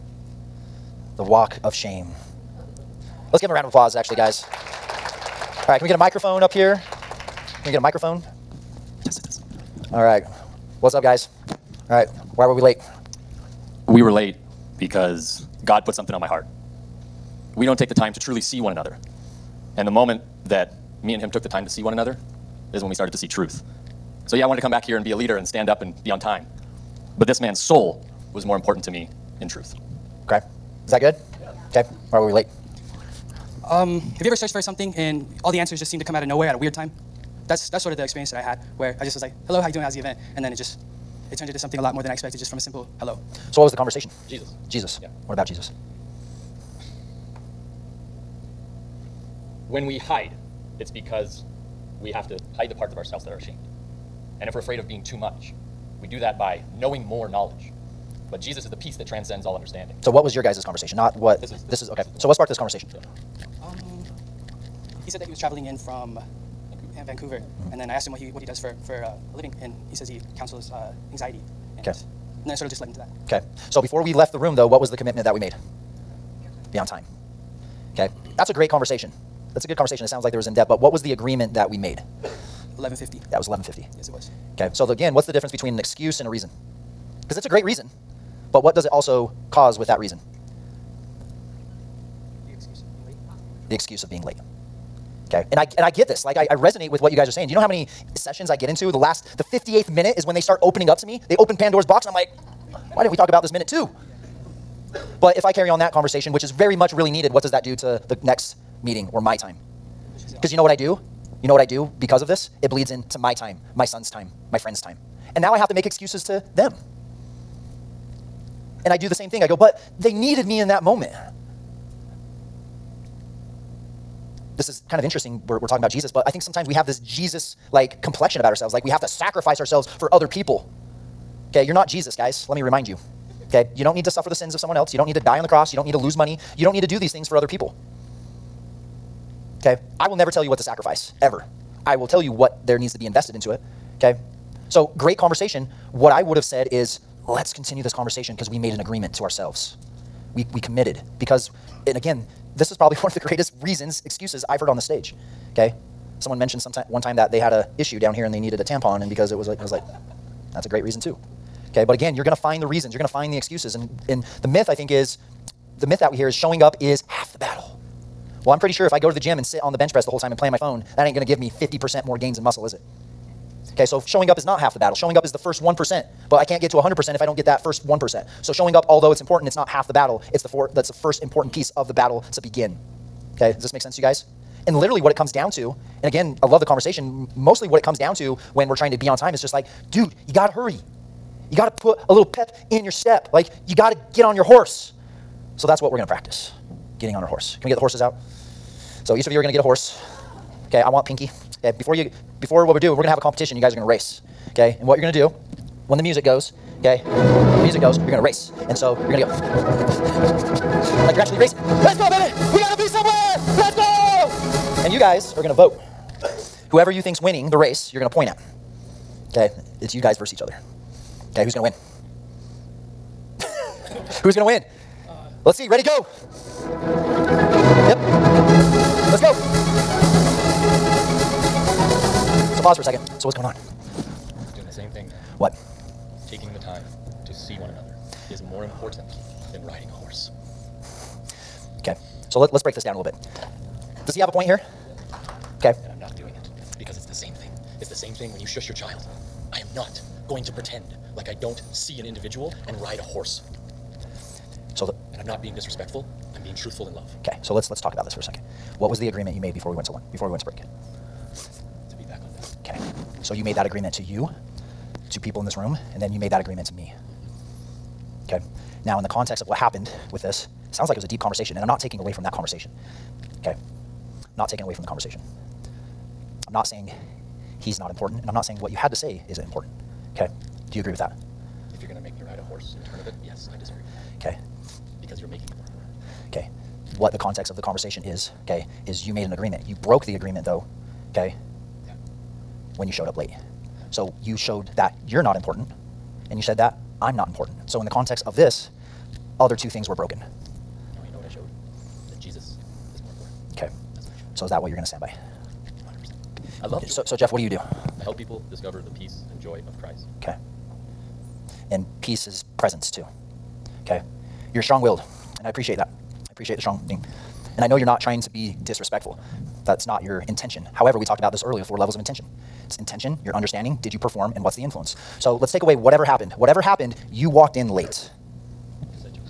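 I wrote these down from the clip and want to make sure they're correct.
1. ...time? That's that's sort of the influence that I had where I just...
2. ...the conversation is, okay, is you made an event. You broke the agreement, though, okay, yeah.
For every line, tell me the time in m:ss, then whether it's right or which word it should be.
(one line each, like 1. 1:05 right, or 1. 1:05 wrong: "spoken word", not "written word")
1. 0:36 wrong: "experience", not "influence"
2. 4:47 wrong: "agreement", not "event".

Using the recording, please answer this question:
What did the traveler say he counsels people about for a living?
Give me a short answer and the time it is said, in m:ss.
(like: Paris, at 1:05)
Anxiety, at 1:11.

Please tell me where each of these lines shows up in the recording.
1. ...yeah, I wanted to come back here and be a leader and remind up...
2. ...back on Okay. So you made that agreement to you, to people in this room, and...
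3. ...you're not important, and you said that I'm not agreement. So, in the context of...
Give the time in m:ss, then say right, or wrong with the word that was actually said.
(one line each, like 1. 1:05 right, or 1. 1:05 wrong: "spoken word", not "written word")
1. 0:24 wrong: "stand", not "remind"
2. 4:22 right
3. 4:55 wrong: "important", not "agreement".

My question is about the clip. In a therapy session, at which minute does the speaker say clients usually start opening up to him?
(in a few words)
58th minute.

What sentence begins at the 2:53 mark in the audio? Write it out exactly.
Okay, so showing up is not half the battle.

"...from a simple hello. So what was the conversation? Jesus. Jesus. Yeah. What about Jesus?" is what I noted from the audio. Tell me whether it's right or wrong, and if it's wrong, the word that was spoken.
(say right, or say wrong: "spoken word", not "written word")
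right.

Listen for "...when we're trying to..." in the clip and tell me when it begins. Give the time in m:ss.
3:08.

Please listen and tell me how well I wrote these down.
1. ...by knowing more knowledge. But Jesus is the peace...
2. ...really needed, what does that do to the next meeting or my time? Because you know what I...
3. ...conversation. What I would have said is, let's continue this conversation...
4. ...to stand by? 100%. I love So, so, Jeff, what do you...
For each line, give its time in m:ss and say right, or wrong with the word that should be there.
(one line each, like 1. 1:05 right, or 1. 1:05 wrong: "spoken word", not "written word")
1. 0:56 right
2. 1:46 right
3. 2:25 right
4. 5:04 right.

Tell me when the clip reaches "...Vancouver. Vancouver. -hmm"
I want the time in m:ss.
1:06.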